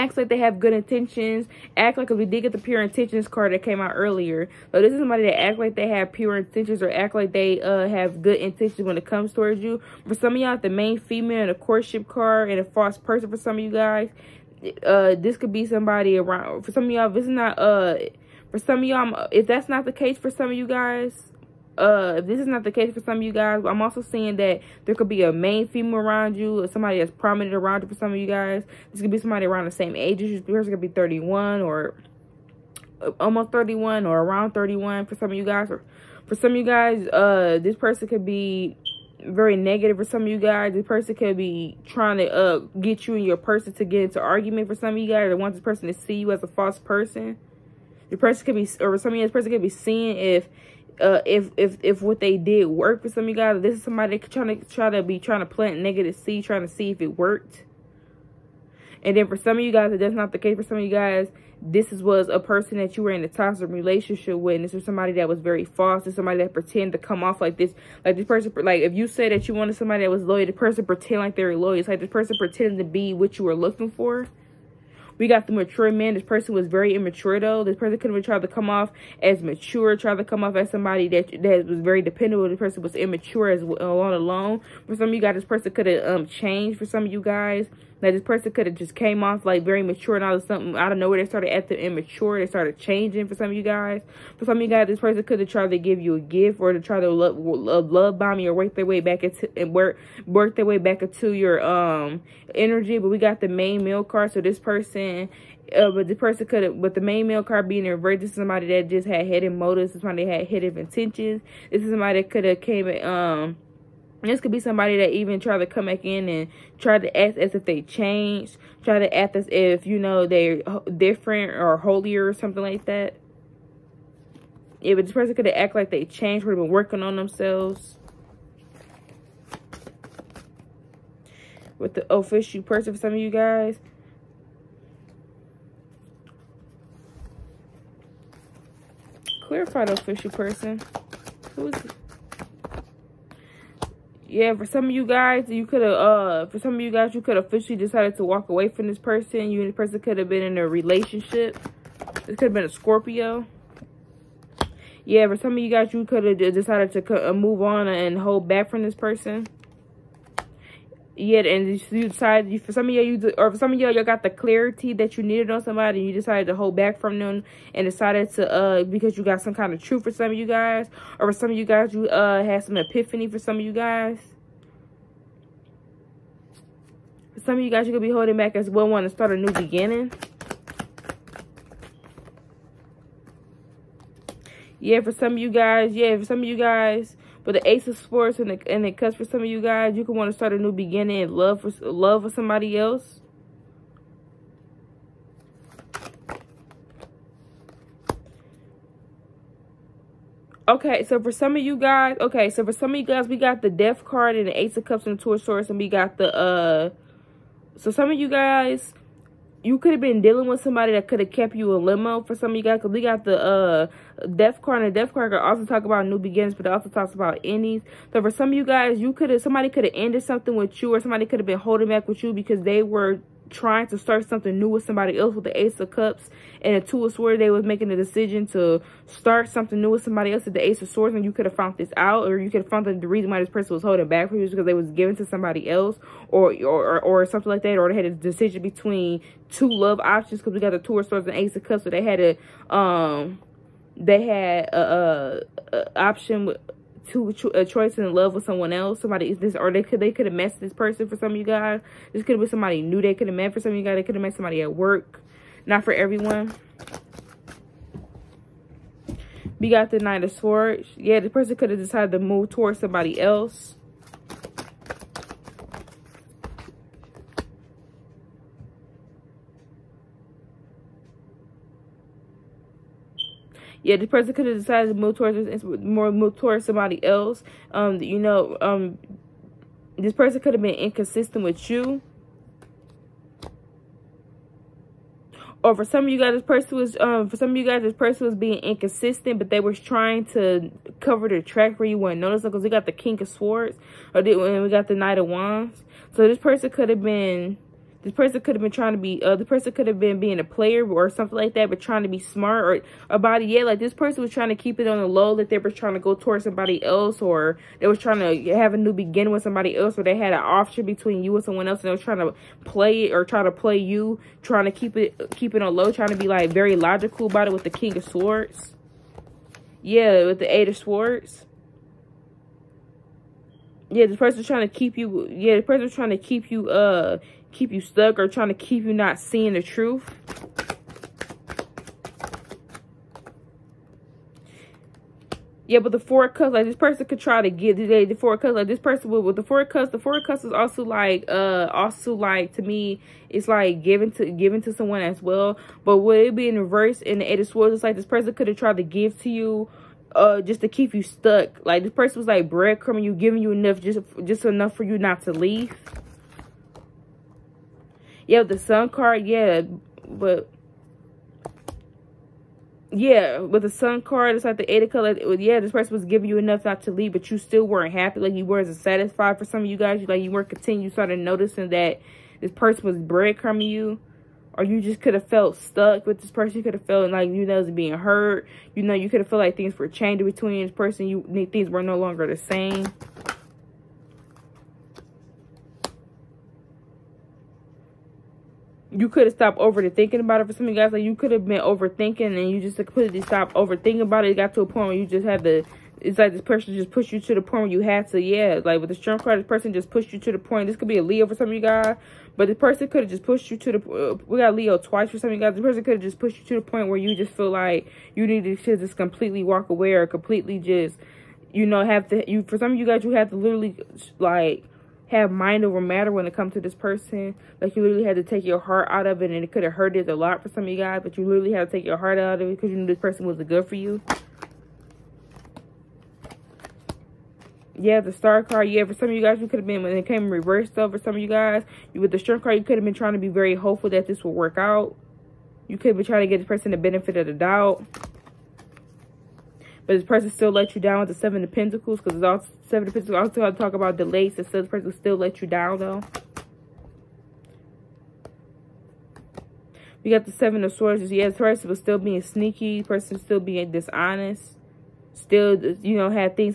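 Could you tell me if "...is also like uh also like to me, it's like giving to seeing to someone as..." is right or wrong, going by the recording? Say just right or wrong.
wrong.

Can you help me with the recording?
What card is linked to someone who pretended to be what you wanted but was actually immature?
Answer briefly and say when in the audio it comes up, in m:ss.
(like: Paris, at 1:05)
mature man, at 1:15.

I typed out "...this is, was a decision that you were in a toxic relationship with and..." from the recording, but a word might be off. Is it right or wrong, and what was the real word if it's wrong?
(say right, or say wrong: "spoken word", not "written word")
wrong: "person", not "decision".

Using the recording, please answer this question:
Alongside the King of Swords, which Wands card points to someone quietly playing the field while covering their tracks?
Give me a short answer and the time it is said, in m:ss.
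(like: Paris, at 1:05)
Knight of Wands, at 4:54.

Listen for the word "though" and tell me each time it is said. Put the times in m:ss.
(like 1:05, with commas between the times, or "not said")
1:17, 7:10, 7:25.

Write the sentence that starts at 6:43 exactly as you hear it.
Uh, we got Leo twice for some of you guys.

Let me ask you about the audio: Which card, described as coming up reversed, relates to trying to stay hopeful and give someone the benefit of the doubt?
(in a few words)
Star card.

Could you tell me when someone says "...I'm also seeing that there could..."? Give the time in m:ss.
0:23.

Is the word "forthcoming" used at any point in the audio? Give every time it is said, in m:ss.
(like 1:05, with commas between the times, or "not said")
not said.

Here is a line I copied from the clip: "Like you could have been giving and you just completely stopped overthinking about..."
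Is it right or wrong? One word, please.
wrong.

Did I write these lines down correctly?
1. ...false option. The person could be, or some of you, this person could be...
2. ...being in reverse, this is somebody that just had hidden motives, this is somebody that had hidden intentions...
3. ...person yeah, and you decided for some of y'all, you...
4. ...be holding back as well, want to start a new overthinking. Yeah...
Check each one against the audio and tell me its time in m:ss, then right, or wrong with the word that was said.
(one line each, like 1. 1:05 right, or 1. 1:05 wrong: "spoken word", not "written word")
1. 0:46 wrong: "person", not "option"
2. 1:47 right
3. 2:38 right
4. 2:58 wrong: "beginning", not "overthinking".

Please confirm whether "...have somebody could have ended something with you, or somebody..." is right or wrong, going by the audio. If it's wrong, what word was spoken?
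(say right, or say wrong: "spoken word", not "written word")
right.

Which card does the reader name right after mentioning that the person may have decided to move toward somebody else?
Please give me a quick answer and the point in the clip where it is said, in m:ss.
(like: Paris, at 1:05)
Knight of Swords, at 4:19.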